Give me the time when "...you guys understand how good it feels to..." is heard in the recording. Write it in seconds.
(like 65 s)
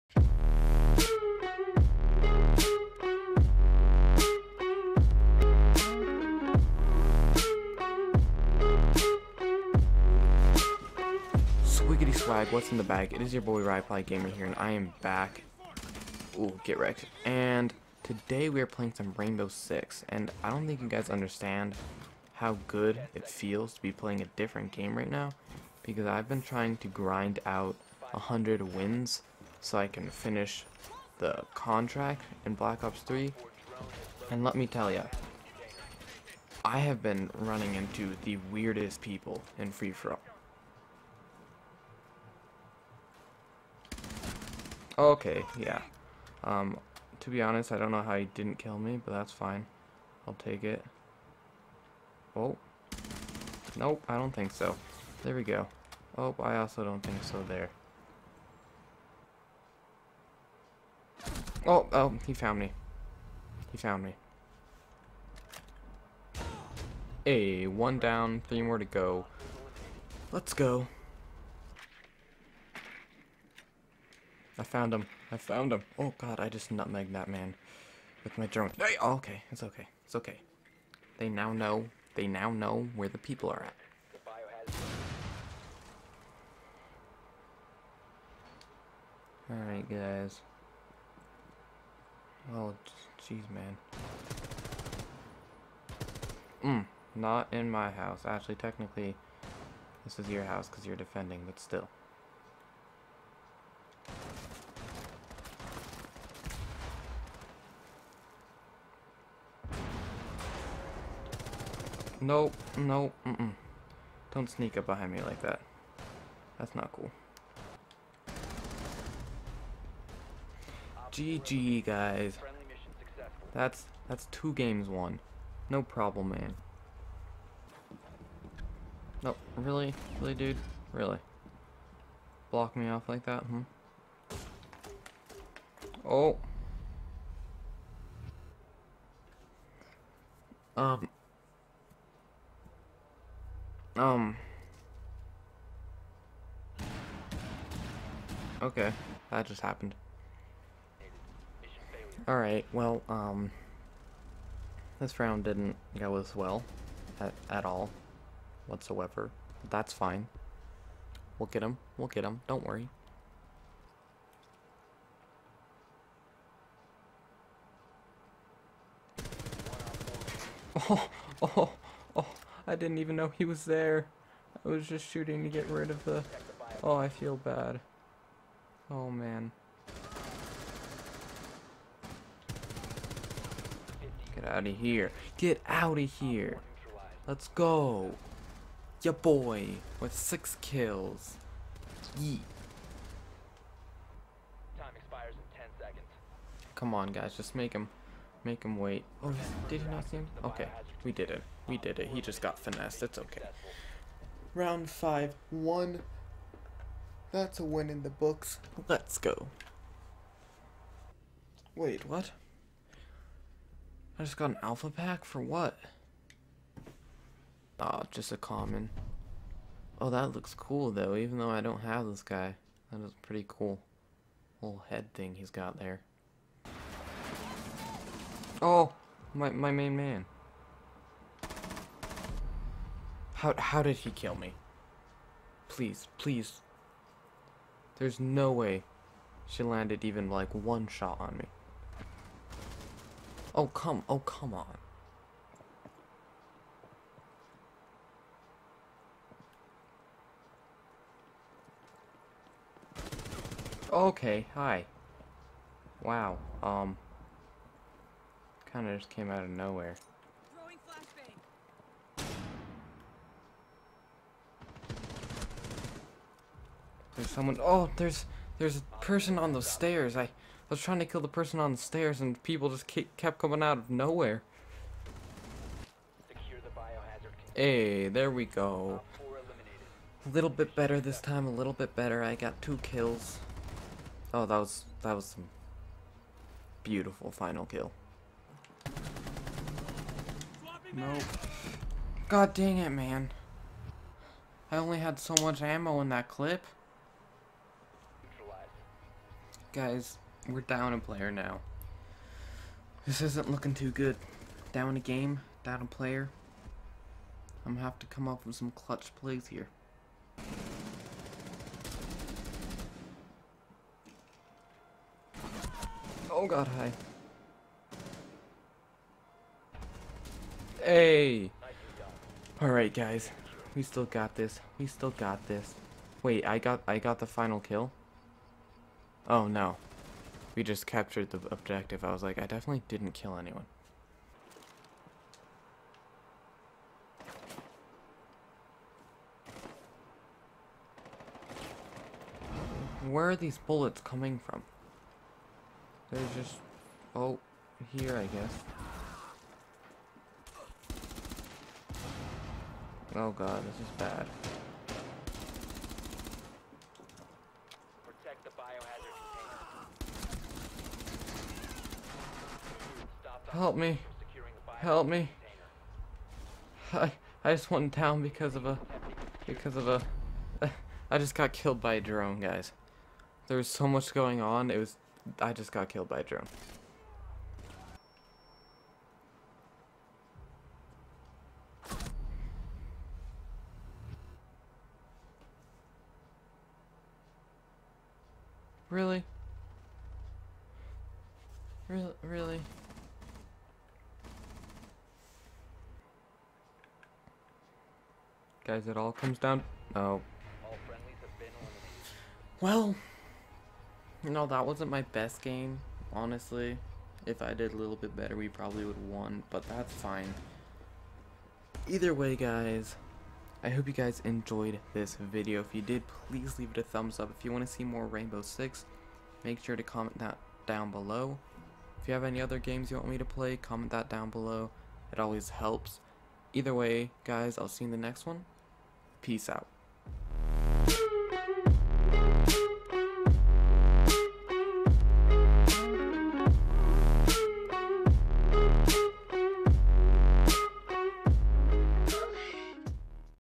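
20 s.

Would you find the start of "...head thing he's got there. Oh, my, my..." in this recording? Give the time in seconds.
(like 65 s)
224 s.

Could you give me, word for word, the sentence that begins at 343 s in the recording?
Where are these bullets coming from?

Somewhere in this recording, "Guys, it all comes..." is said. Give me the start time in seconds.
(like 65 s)
398 s.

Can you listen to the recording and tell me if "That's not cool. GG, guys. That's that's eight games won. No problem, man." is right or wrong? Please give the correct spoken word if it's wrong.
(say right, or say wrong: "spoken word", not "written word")
wrong: "two", not "eight".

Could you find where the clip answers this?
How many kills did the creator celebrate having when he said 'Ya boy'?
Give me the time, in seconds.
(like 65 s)
190 s.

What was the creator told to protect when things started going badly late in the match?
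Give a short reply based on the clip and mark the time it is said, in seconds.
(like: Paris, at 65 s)
Biohazard container, at 358 s.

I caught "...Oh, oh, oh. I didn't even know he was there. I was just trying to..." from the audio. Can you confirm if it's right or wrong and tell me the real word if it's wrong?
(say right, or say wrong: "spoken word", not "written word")
wrong: "shooting", not "trying".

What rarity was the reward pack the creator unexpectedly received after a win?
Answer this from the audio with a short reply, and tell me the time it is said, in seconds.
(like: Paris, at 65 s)
Common, at 218 s.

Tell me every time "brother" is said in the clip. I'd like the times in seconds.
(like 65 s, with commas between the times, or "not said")
not said.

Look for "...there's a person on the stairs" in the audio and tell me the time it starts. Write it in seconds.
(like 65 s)
268 s.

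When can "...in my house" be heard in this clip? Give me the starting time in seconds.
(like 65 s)
97 s.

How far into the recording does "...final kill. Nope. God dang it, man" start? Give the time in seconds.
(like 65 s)
287 s.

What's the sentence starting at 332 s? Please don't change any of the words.
I was like, I definitely didn't kill anyone.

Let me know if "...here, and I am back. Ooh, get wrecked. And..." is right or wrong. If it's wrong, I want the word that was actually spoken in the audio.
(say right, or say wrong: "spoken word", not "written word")
right.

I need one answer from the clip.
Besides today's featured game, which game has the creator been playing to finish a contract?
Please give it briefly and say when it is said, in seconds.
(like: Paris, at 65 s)
Black Ops 3, at 32 s.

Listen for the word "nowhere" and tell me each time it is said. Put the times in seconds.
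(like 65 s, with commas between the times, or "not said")
259 s, 273 s.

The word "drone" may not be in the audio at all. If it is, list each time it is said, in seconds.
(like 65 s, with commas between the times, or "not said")
78 s, 372 s, 376 s.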